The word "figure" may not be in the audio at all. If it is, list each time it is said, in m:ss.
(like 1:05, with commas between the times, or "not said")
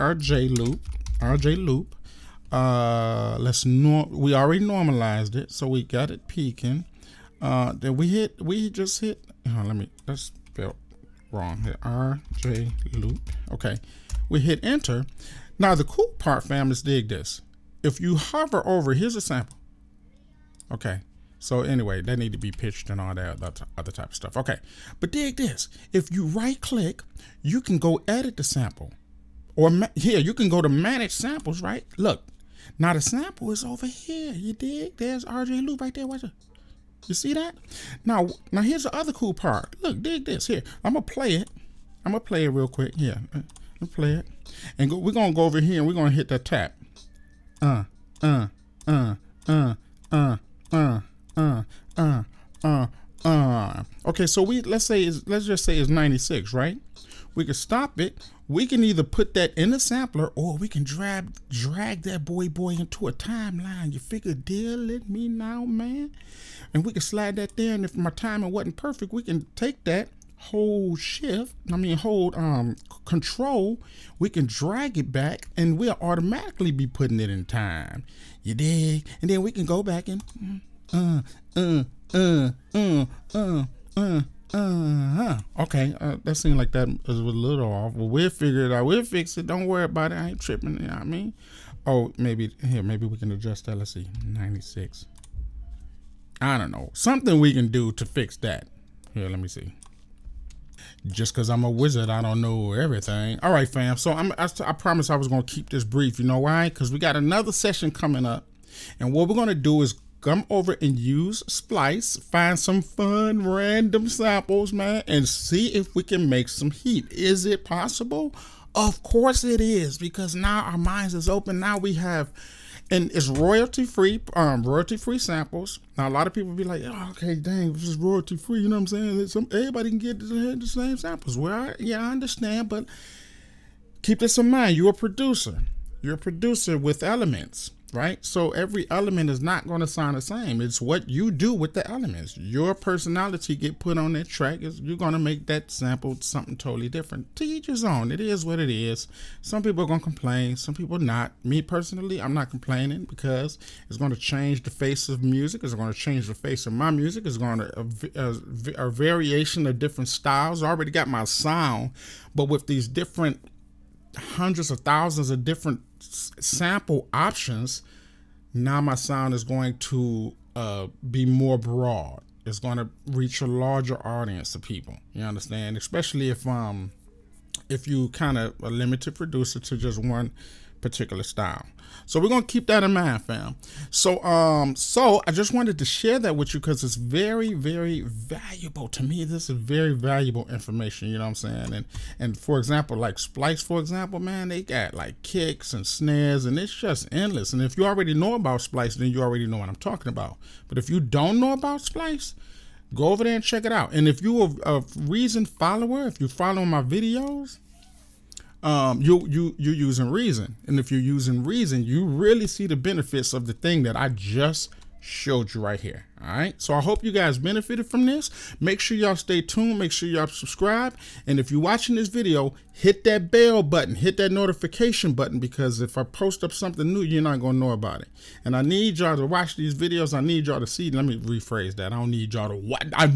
1:03, 1:28.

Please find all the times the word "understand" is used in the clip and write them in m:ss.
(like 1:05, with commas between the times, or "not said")
2:12, 2:55.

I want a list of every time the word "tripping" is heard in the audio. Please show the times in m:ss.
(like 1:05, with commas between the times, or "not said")
1:30.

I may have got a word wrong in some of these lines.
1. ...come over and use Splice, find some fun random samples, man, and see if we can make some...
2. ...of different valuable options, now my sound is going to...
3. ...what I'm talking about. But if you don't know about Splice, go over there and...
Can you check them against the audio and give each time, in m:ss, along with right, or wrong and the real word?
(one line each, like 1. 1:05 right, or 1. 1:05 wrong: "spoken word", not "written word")
1. 1:50 right
2. 2:45 wrong: "sample", not "valuable"
3. 3:19 right.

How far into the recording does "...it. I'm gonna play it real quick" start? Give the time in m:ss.
0:41.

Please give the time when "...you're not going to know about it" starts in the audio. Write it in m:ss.
3:46.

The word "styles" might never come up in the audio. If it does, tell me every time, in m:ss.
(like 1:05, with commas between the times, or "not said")
2:40, 3:01.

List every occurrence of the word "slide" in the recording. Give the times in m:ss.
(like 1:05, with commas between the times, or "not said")
1:07.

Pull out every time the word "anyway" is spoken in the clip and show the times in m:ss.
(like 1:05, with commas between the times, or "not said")
0:21.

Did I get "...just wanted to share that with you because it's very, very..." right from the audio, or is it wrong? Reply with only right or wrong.
right.